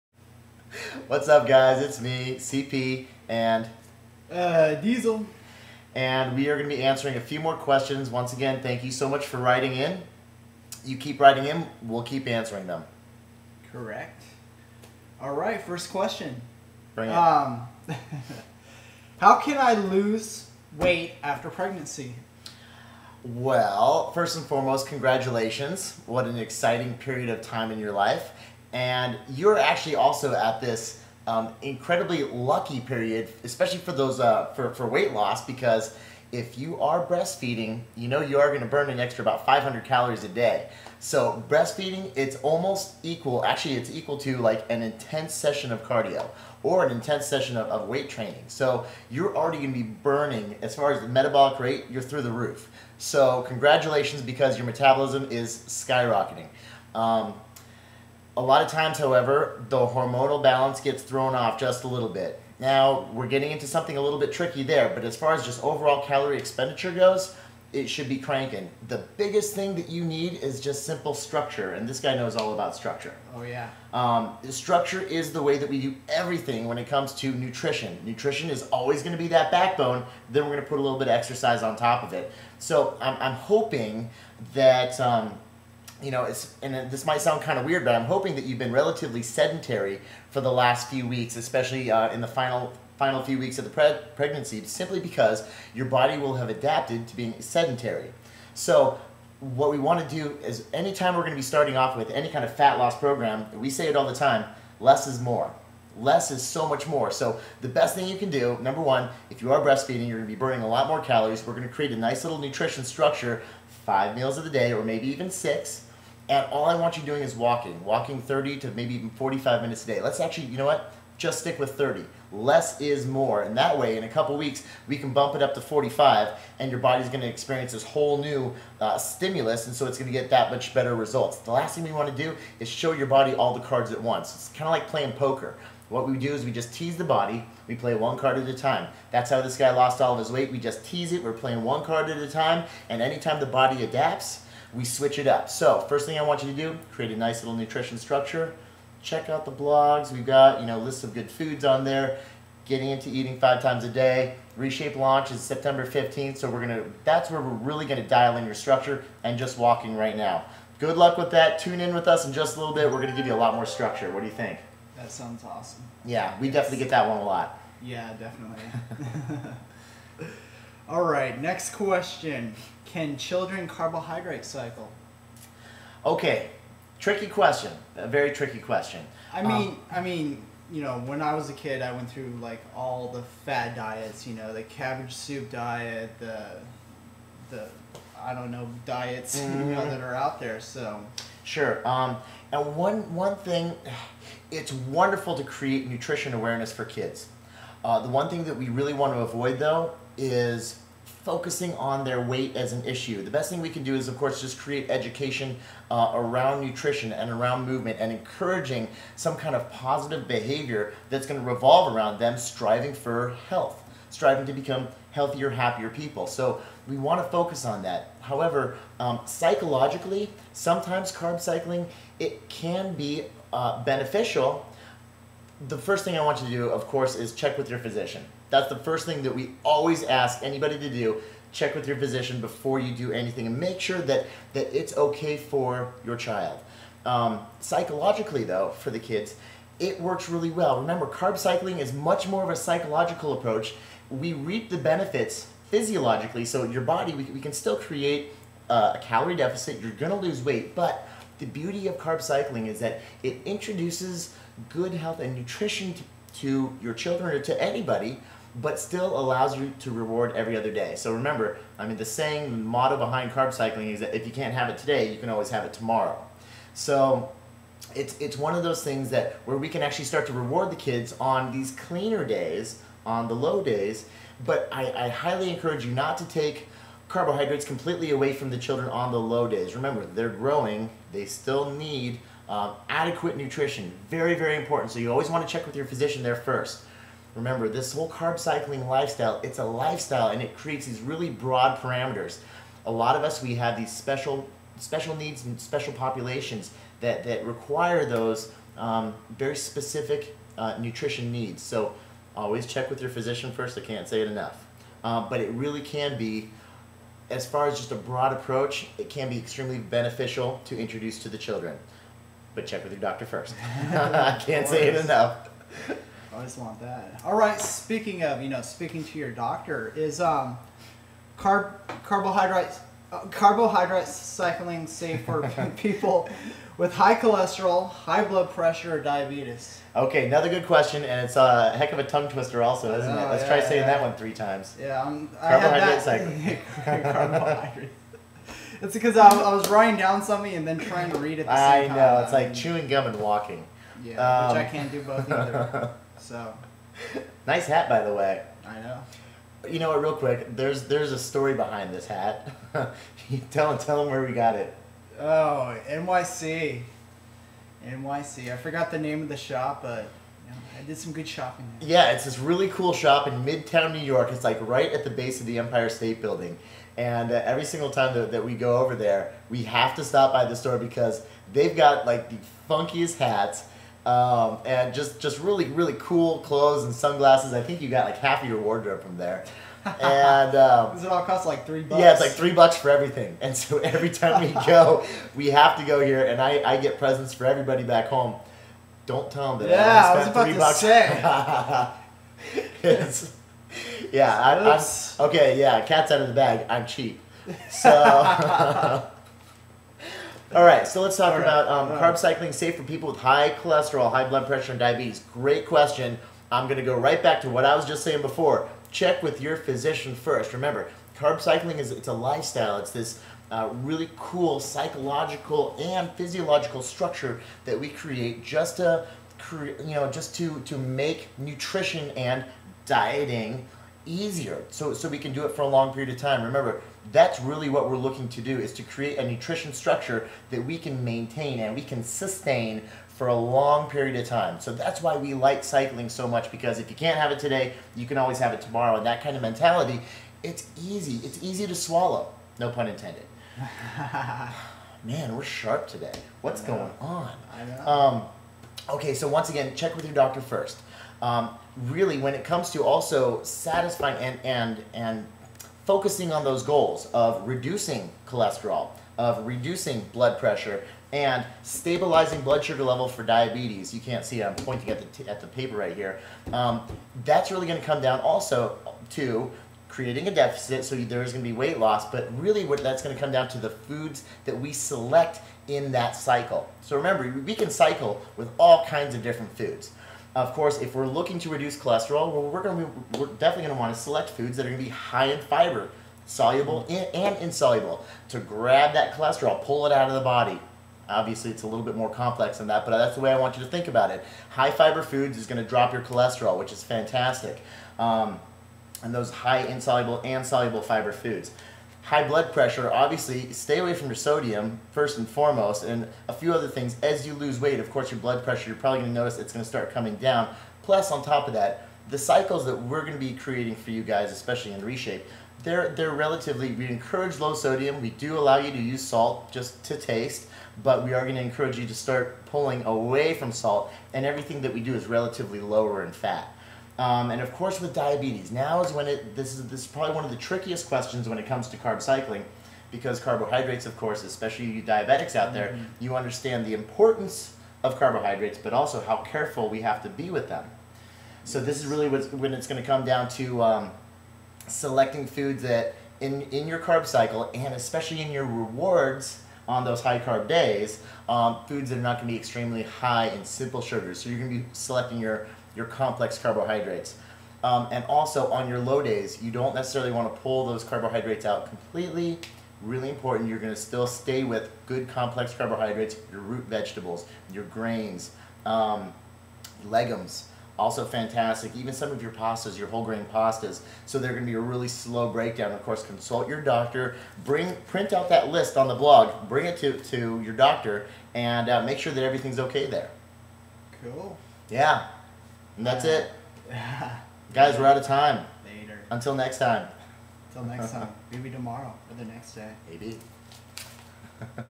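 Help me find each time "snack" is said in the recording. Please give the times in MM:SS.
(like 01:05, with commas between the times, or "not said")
not said.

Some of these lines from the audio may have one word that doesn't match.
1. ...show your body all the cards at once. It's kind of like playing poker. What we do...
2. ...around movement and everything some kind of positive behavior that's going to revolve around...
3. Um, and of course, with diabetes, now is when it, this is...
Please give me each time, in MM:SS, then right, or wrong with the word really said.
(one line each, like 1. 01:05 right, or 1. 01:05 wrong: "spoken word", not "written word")
1. 02:12 right
2. 03:27 wrong: "encouraging", not "everything"
3. 08:46 right.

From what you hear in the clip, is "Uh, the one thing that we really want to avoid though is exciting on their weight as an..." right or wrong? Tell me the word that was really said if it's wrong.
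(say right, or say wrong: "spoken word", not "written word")
wrong: "focusing", not "exciting".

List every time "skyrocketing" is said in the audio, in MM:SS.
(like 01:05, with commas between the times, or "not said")
00:55.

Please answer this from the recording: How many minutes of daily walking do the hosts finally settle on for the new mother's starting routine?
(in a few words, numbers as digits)
30.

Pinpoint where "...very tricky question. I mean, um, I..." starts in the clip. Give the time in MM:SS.
02:58.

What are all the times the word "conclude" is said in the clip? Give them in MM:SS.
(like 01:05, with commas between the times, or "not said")
not said.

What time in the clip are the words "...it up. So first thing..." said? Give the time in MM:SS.
02:25.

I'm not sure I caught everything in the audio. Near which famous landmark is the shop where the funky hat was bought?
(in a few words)
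Empire State Building.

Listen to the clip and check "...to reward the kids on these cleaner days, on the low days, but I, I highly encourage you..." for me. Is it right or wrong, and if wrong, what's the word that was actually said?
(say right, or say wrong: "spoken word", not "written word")
right.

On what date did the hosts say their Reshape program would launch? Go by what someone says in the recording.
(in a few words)
September 15th.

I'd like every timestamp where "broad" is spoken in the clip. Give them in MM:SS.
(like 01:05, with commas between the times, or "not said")
04:51, 05:07.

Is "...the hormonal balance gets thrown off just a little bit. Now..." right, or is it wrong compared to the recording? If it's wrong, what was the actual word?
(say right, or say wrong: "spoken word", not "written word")
right.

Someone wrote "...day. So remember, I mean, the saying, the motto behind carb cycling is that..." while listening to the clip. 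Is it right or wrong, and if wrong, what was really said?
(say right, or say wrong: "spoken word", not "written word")
right.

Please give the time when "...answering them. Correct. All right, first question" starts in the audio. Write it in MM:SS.
00:12.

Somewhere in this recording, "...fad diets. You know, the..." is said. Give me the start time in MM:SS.
03:03.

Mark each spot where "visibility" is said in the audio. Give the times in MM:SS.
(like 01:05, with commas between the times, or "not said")
not said.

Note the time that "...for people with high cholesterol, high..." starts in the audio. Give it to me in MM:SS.
06:42.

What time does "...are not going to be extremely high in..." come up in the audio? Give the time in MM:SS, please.
09:11.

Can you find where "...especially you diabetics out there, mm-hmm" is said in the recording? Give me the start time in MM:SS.
08:54.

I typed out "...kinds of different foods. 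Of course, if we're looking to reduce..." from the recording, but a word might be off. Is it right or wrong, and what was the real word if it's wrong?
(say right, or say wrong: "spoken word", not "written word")
right.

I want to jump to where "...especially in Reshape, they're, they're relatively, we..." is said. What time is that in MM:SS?
08:34.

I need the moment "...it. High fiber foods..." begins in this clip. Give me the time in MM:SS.
08:14.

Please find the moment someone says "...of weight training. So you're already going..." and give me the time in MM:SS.
00:47.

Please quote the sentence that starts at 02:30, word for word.
We've got, you know, lists of good foods on there.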